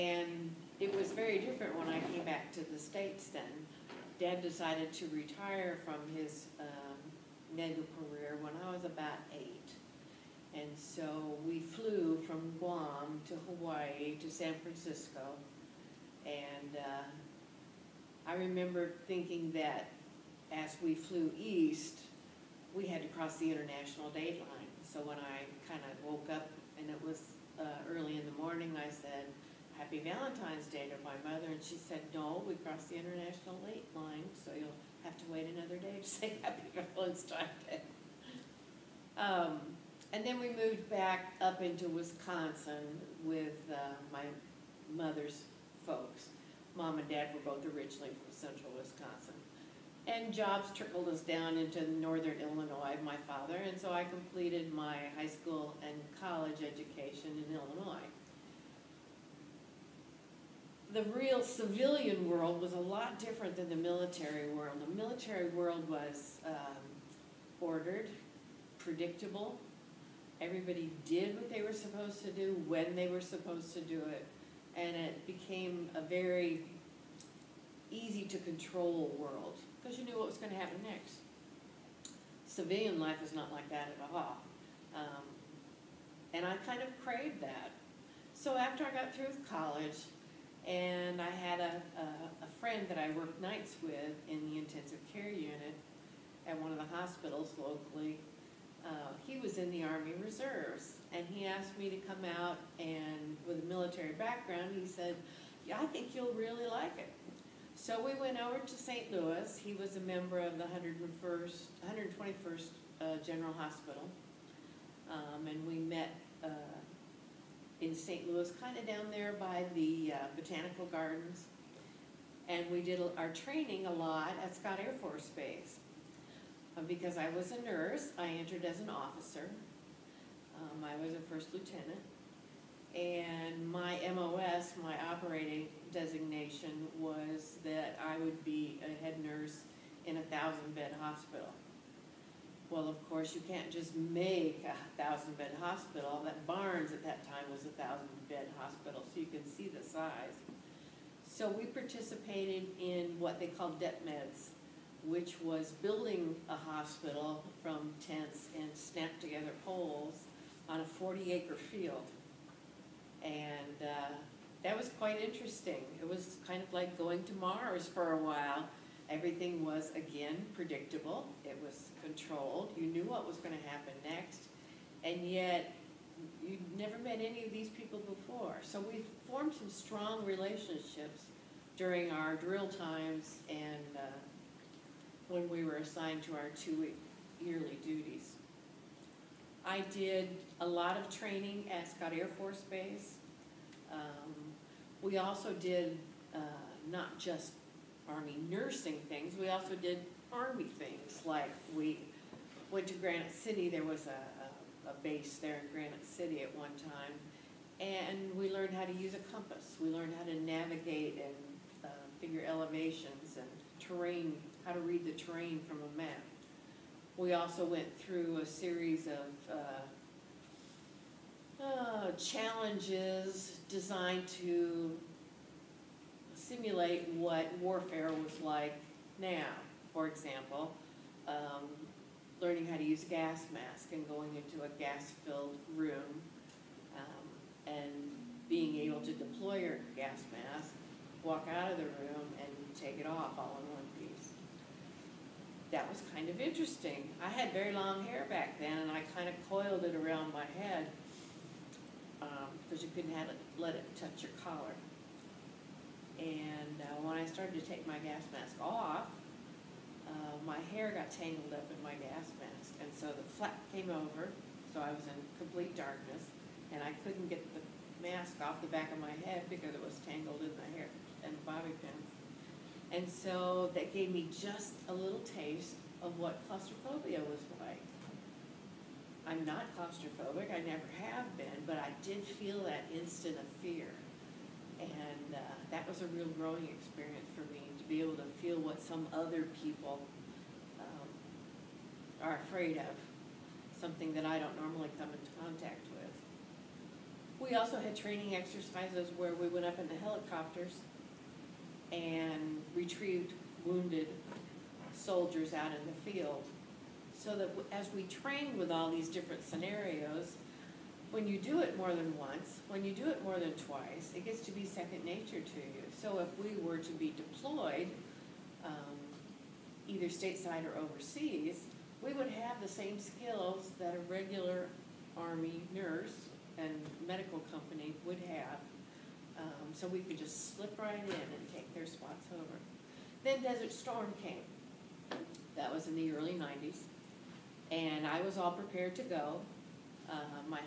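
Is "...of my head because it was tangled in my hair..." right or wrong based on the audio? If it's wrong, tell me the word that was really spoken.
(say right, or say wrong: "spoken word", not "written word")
right.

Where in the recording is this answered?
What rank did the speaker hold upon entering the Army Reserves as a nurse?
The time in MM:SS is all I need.
02:11.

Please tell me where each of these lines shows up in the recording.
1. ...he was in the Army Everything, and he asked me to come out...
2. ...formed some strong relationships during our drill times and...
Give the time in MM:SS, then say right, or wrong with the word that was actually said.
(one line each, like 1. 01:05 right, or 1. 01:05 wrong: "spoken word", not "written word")
1. 01:39 wrong: "Reserves", not "Everything"
2. 02:59 right.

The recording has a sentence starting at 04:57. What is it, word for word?
We also had training exercises where we went up in the helicopters and retrieved wounded soldiers out in the field.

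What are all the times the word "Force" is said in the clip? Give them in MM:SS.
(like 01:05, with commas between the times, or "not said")
02:05, 03:12.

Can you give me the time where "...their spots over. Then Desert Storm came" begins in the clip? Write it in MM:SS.
05:31.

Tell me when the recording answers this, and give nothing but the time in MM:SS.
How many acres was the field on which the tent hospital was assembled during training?
02:40.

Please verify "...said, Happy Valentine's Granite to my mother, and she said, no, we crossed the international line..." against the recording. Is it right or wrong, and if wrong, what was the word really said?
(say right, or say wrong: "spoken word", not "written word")
wrong: "Day", not "Granite".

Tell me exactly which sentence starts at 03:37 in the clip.
We also went through a series of uh, uh, challenges designed to simulate what warfare was like now.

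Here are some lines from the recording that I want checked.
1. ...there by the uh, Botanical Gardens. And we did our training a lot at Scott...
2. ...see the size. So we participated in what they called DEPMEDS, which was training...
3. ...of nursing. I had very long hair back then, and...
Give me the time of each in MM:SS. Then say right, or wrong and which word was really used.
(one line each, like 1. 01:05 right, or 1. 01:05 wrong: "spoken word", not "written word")
1. 01:59 right
2. 02:29 wrong: "building", not "training"
3. 04:06 wrong: "interesting", not "nursing".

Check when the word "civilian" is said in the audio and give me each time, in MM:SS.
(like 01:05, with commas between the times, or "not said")
01:01, 01:22.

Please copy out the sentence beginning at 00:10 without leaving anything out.
And so we flew from Guam to Hawaii to San Francisco.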